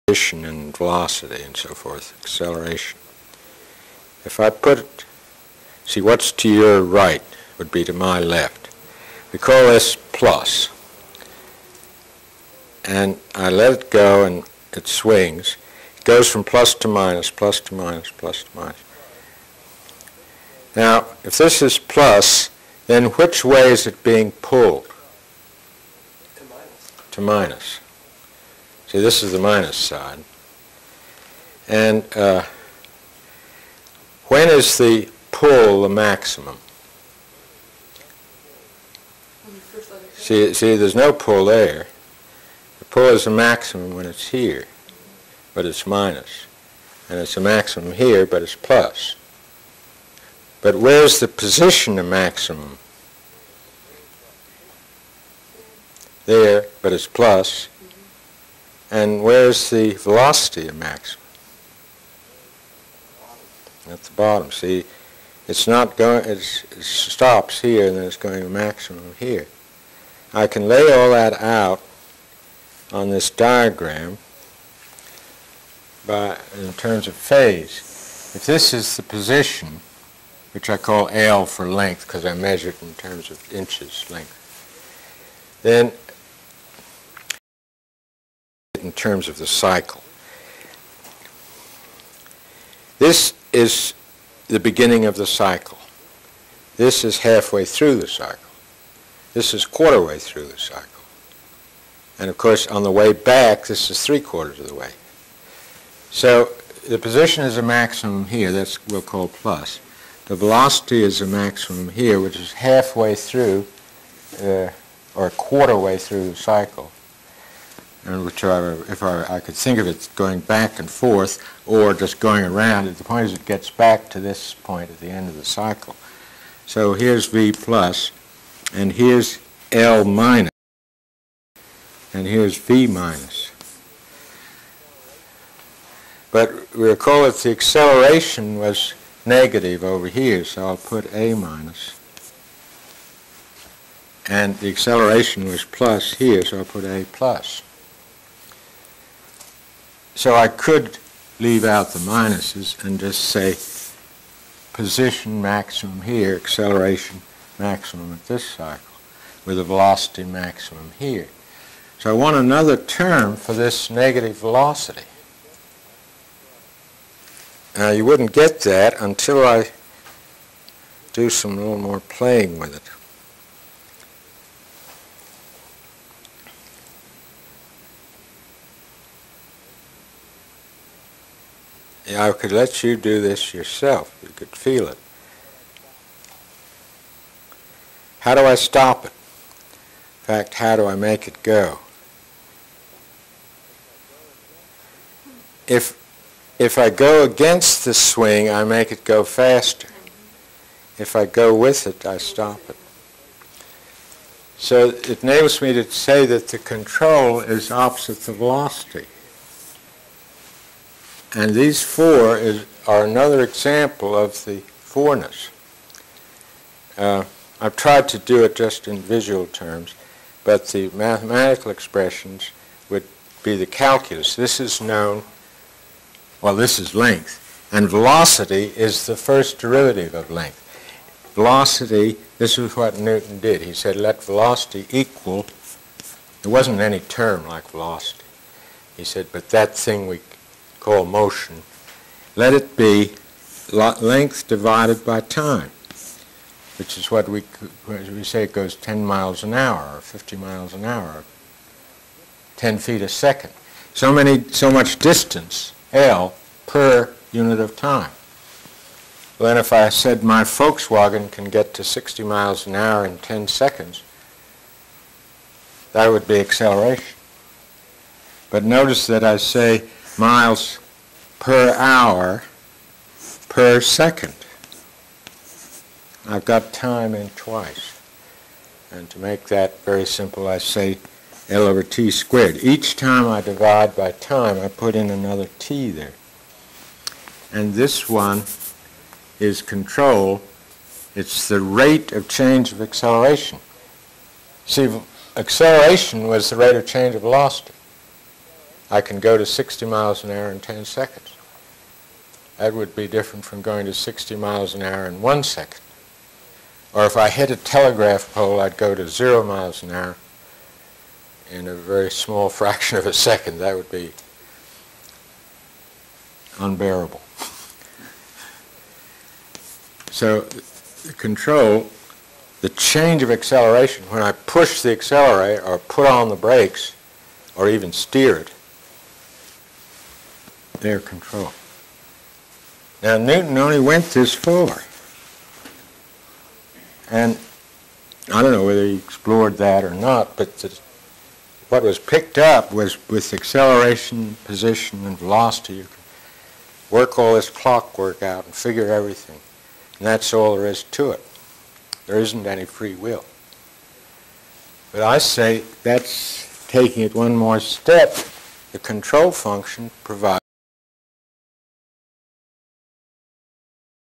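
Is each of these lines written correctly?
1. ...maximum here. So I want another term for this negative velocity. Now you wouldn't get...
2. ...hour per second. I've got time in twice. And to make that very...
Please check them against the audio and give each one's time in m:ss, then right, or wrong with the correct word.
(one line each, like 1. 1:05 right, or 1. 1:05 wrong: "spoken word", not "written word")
1. 2:40 right
2. 4:31 right.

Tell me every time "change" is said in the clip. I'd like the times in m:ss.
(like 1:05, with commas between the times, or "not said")
4:52, 4:56, 5:22.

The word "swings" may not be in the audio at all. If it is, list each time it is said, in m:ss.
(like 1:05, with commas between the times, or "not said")
0:14, 3:17.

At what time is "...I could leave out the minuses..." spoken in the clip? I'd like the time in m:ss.
2:30.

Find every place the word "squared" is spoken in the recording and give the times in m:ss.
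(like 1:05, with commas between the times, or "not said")
4:42.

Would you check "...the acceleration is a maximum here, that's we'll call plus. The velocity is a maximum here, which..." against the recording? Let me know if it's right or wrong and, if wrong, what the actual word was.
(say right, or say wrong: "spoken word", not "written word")
wrong: "position", not "acceleration".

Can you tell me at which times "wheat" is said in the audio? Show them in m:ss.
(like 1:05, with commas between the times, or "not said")
not said.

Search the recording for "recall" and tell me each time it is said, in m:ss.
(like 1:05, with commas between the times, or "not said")
2:16.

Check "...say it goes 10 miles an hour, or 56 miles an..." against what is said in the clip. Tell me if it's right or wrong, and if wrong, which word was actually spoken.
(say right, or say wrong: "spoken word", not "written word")
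wrong: "50", not "56".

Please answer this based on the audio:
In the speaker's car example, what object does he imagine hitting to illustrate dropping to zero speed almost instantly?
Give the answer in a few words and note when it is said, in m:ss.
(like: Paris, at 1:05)
A telegraph pole, at 5:07.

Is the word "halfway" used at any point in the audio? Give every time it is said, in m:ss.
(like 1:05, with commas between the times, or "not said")
1:37, 1:52.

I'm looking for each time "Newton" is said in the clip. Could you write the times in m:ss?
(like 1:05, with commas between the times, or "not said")
3:52, 5:33.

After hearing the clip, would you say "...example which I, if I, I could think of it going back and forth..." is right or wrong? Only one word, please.
wrong.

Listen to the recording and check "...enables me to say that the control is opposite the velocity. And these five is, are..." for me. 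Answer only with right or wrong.
wrong.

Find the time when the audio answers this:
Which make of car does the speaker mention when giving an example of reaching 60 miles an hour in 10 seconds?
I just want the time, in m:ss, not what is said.
4:20.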